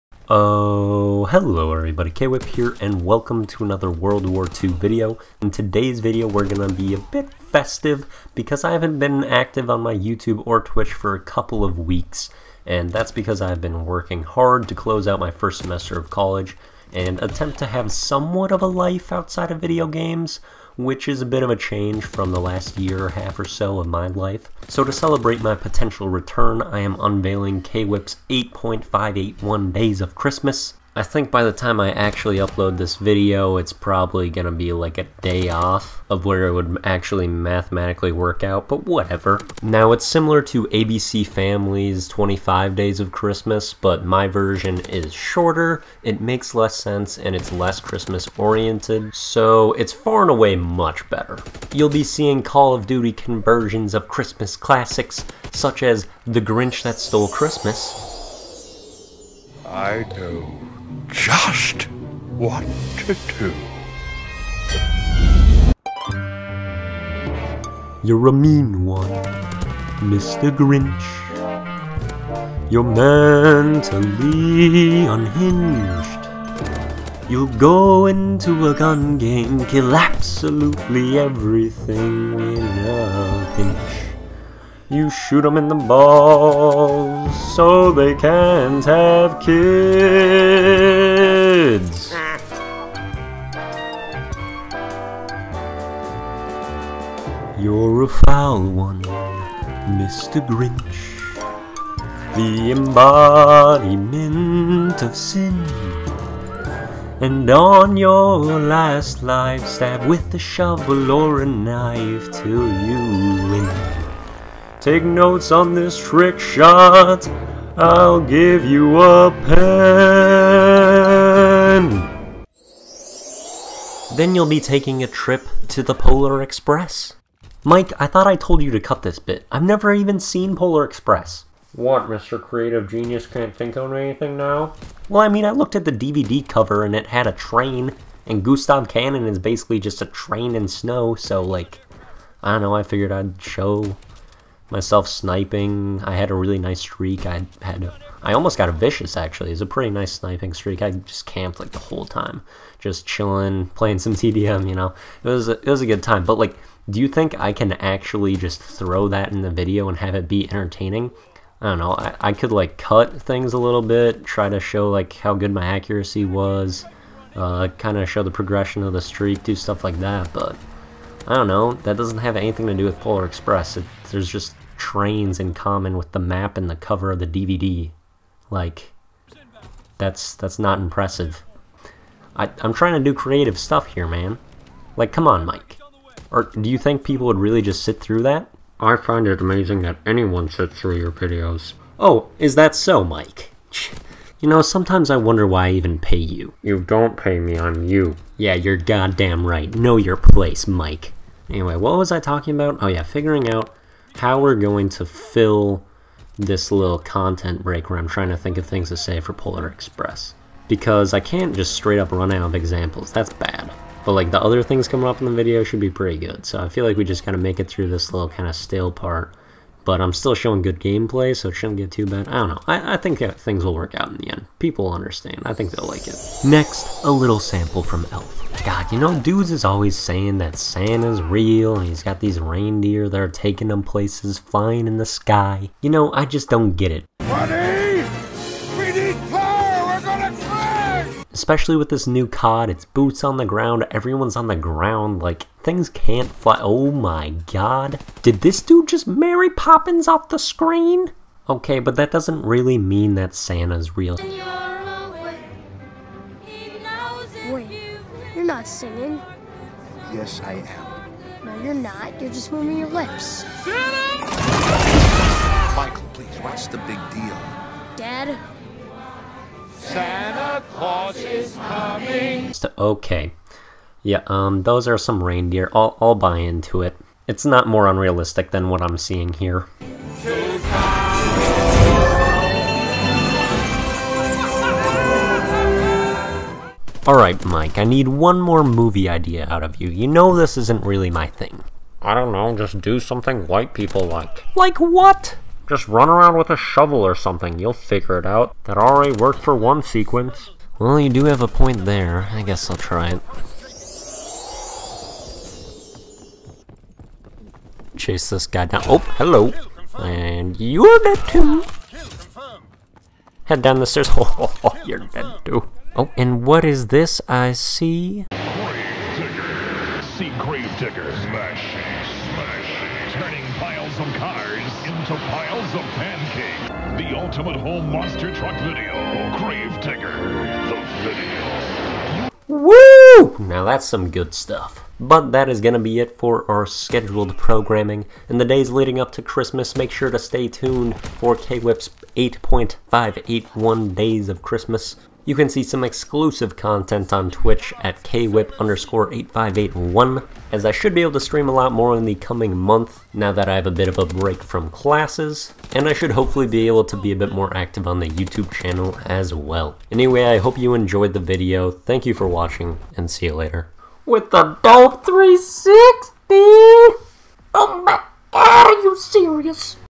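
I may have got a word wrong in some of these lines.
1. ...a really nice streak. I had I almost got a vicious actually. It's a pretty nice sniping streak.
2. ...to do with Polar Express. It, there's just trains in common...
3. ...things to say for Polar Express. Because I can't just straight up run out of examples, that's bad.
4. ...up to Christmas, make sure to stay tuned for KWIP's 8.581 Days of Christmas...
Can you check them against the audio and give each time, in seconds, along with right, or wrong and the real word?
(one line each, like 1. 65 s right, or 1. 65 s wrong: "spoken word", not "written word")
1. 146 s right
2. 172 s right
3. 208 s right
4. 338 s right.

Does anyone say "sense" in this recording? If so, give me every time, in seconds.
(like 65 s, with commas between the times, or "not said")
46 s.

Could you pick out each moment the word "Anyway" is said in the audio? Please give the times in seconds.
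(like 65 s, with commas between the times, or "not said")
201 s, 359 s.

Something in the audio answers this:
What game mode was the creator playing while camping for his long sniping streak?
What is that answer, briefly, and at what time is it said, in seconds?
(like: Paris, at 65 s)
TDM, at 154 s.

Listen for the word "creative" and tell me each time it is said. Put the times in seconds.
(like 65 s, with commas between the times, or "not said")
132 s, 183 s.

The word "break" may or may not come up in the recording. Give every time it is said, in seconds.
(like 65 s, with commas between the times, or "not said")
207 s, 354 s.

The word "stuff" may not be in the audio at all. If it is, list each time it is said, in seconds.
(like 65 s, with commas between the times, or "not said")
169 s, 183 s, 334 s.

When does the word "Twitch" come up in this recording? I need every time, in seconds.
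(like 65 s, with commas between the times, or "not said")
10 s, 347 s.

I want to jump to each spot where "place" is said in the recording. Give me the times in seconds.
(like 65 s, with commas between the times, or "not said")
200 s, 233 s.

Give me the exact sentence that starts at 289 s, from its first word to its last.
You know this isn't really my thing.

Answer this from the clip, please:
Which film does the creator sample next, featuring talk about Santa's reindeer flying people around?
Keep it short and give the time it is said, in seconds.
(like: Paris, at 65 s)
Elf, at 228 s.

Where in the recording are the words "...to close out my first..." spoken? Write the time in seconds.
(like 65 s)
14 s.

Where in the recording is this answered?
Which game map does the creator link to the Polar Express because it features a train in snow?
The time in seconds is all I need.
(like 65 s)
138 s.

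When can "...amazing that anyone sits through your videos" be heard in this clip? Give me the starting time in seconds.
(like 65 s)
189 s.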